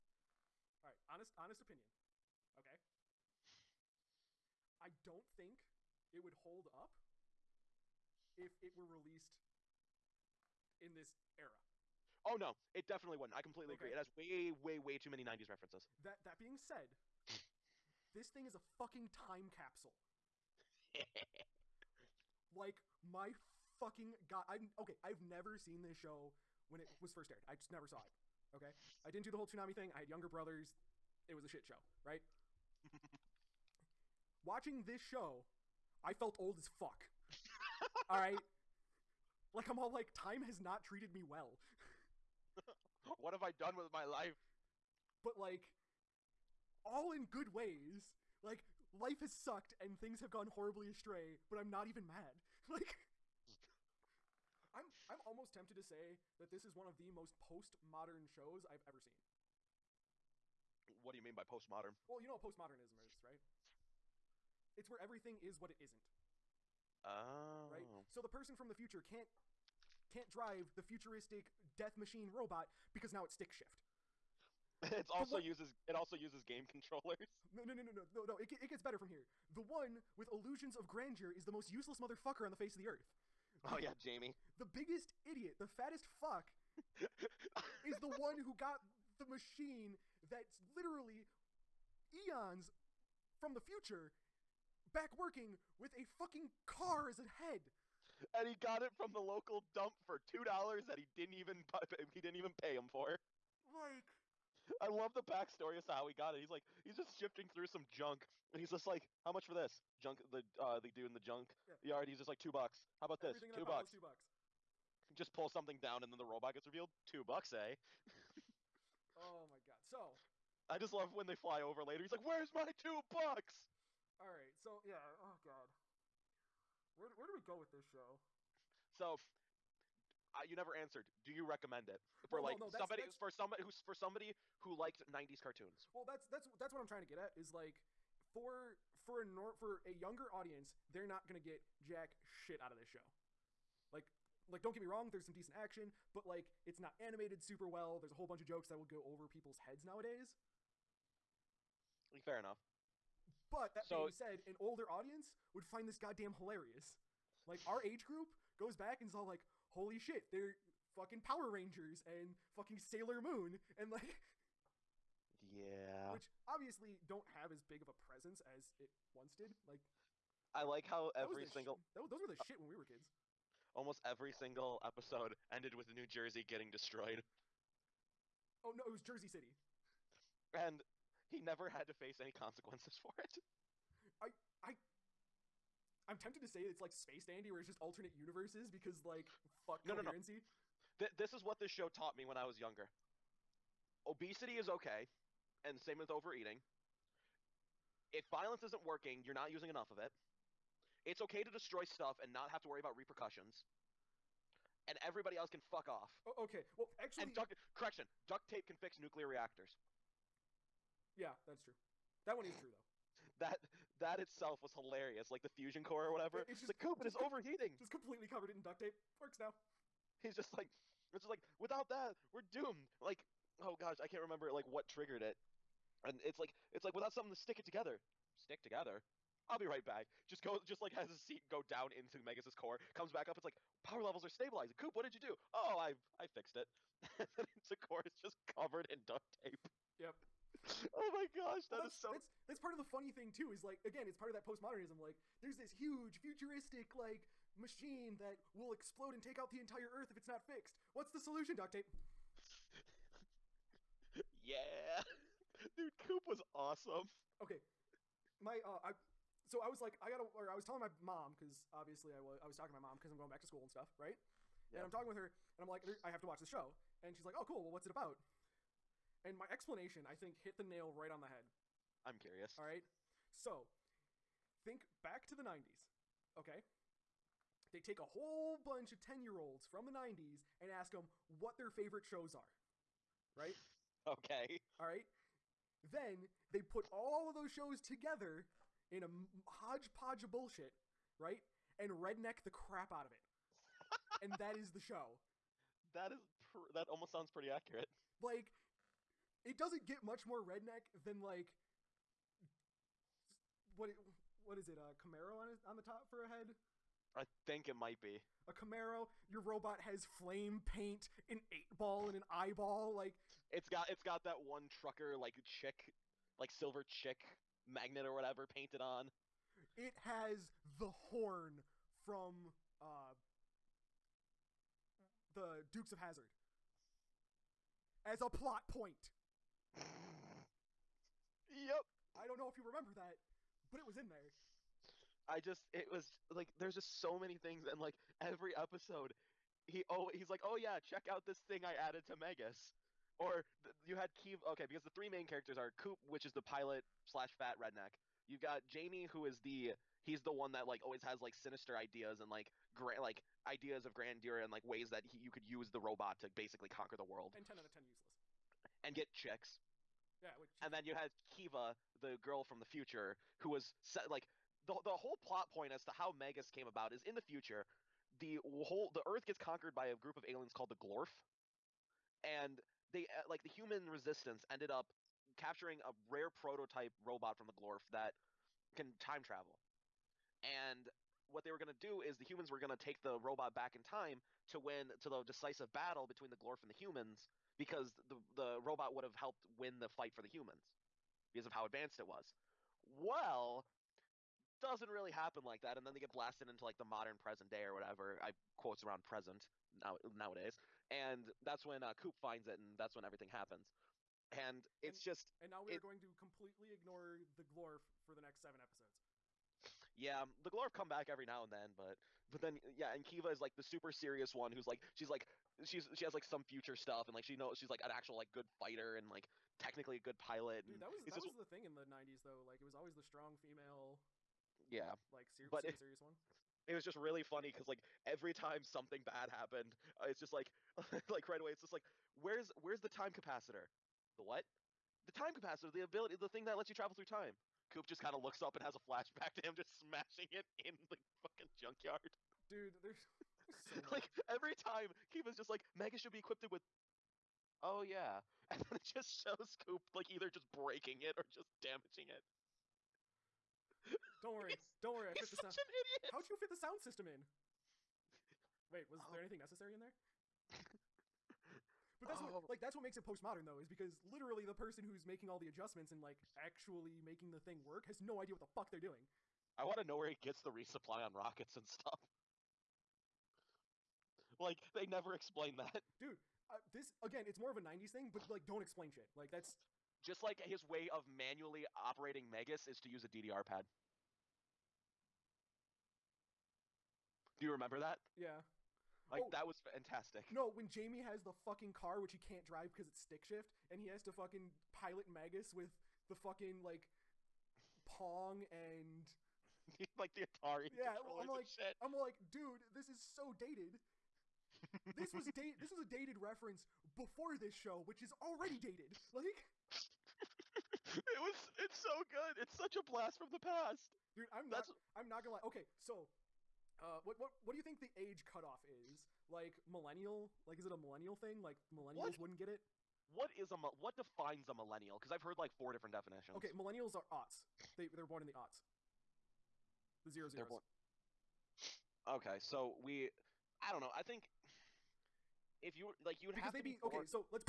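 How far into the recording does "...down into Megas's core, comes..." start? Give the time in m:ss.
3:51.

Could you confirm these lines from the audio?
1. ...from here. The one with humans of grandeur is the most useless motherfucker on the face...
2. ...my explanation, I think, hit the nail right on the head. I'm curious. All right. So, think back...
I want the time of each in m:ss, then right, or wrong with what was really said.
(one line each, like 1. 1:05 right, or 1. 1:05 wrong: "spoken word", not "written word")
1. 1:18 wrong: "illusions", not "humans"
2. 4:29 right.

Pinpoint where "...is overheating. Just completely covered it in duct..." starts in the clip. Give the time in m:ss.
3:37.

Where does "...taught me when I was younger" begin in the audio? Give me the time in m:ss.
3:11.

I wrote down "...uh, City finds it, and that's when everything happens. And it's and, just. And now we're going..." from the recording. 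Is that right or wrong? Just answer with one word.
wrong.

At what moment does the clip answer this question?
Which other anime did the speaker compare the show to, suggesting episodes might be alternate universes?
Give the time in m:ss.
3:06.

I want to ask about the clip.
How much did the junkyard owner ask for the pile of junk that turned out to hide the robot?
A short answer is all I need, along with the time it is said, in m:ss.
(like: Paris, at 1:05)
2 dollars, at 1:40.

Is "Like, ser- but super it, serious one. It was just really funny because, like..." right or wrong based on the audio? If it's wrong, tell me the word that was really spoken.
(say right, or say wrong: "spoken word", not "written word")
right.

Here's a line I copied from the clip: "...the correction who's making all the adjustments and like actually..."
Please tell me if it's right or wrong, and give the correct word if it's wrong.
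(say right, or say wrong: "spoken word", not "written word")
wrong: "person", not "correction".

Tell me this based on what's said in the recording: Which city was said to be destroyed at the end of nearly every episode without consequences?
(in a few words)
Jersey City.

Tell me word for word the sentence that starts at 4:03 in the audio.
Is like again, it's part of that postmodernism.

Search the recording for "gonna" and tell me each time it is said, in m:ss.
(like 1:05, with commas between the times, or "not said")
2:21, 8:35.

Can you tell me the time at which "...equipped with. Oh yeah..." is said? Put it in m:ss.
7:26.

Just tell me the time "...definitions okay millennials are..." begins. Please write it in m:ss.
8:45.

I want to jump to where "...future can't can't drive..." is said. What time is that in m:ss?
1:08.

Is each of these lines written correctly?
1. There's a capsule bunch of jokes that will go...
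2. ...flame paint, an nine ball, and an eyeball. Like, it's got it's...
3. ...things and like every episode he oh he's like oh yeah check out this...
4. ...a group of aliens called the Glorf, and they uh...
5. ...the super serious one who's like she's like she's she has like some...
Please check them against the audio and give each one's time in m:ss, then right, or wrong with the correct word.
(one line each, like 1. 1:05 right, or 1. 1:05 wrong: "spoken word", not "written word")
1. 2:27 wrong: "whole", not "capsule"
2. 5:10 wrong: "eight", not "nine"
3. 5:37 right
4. 6:09 right
5. 6:53 right.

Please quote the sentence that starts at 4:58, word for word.
Like it doesn't get much more redneck than like what it, what is it?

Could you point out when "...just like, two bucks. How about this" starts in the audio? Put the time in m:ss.
1:52.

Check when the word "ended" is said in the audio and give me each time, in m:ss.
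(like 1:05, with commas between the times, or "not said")
2:55, 6:14.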